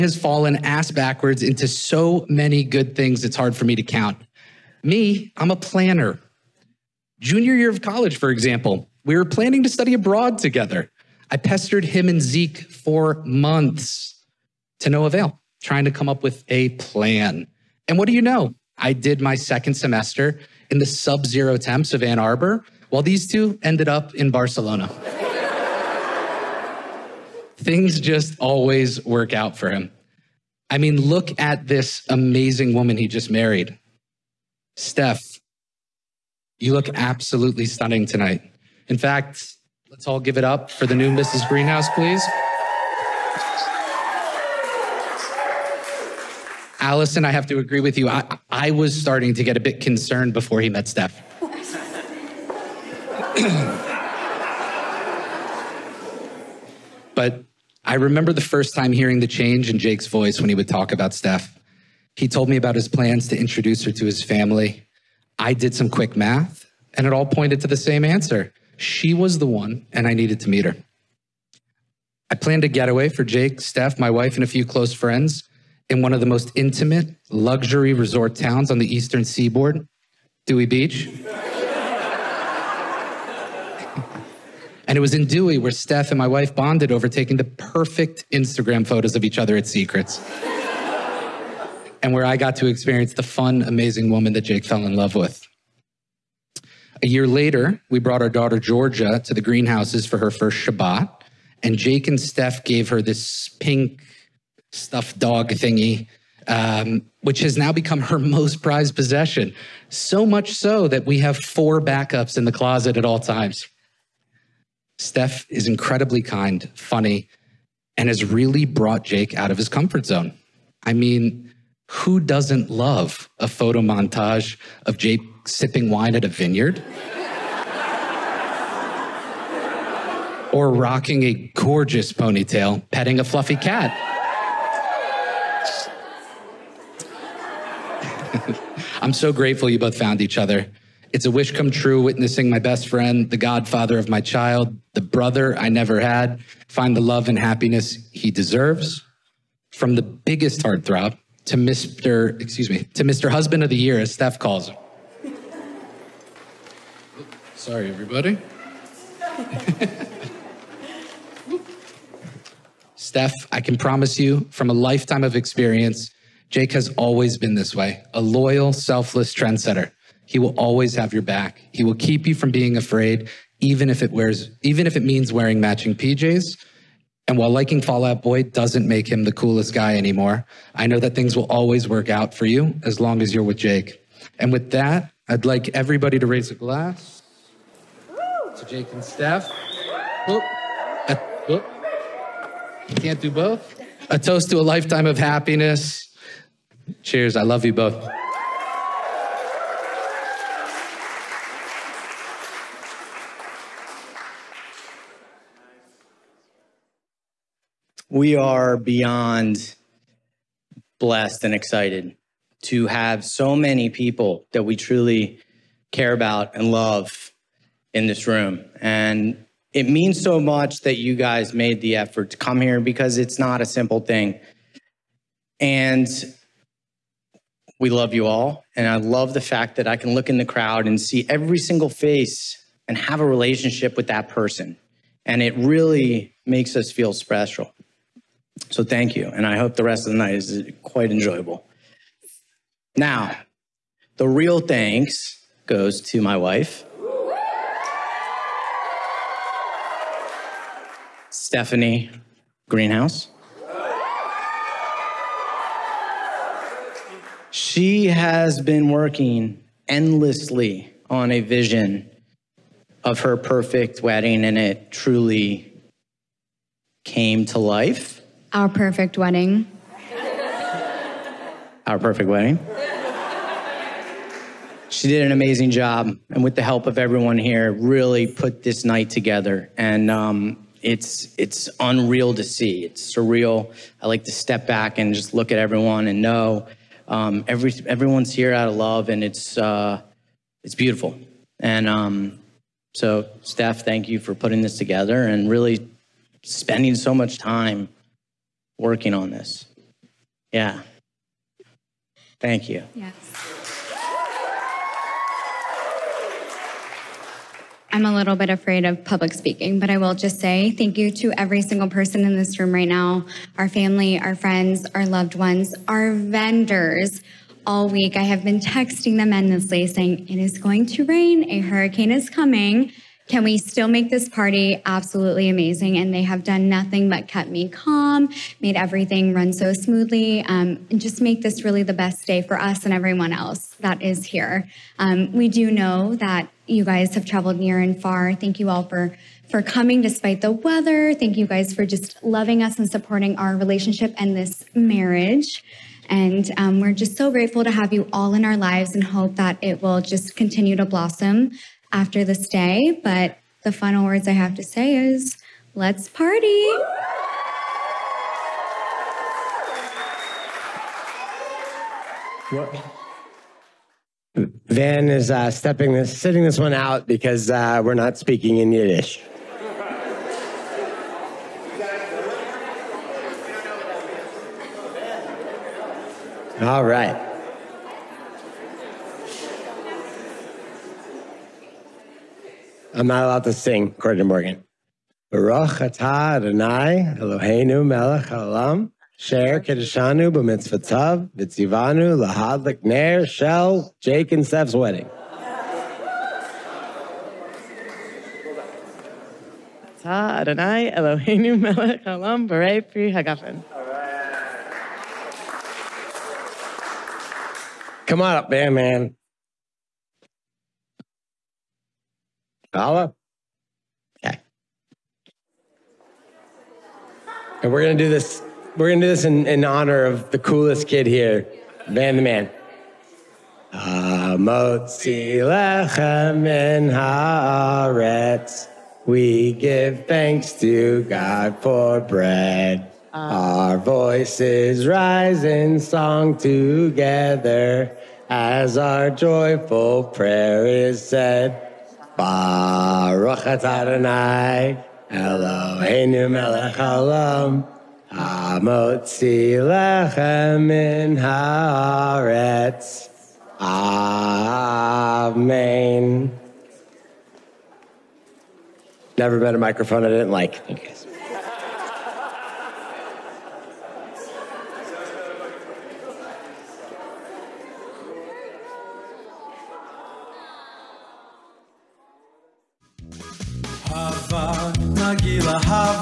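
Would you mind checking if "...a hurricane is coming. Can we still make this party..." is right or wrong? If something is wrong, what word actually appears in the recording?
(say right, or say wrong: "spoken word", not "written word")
right.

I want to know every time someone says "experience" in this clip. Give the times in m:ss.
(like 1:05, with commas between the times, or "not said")
1:32, 2:45.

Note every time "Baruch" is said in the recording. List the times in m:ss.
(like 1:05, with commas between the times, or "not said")
6:25, 7:22.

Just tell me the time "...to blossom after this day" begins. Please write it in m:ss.
5:50.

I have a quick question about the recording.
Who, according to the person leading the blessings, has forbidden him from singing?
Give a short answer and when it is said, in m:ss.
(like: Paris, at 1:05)
Morgan, at 6:24.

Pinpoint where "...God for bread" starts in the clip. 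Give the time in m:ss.
7:11.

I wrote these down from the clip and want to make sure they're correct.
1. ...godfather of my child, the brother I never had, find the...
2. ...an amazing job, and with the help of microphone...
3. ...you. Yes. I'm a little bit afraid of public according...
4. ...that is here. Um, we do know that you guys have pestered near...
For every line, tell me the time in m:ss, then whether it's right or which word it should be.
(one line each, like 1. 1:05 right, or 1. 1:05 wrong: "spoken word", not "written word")
1. 2:23 right
2. 4:35 wrong: "everyone", not "microphone"
3. 5:02 wrong: "speaking", not "according"
4. 5:33 wrong: "traveled", not "pestered".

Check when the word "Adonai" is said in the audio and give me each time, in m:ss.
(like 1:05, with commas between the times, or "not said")
6:26, 6:40, 7:23.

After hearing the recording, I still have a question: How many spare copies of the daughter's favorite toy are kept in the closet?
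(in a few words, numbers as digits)
4.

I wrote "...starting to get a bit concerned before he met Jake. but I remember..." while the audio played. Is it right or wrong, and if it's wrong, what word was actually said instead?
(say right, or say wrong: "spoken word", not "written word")
wrong: "Steph", not "Jake".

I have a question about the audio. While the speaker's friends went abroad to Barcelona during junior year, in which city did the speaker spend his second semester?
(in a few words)
Ann Arbor.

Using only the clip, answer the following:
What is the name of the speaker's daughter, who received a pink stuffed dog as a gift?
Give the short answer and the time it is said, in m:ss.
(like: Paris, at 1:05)
Georgia, at 1:38.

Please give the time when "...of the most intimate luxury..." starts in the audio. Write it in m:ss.
1:16.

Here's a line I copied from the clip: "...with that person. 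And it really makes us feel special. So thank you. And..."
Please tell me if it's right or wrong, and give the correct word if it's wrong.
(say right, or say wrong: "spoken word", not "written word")
right.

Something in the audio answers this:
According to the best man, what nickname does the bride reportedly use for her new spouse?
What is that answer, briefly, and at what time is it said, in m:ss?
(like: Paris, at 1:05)
Husband of the Year, at 2:33.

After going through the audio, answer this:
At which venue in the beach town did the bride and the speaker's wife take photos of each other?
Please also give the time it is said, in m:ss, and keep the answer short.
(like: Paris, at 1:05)
Secrets, at 1:29.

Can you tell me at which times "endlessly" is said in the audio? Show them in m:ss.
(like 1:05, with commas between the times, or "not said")
4:19, 5:19.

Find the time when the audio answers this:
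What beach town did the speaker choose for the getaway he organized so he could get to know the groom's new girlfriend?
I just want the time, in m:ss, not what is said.
1:20.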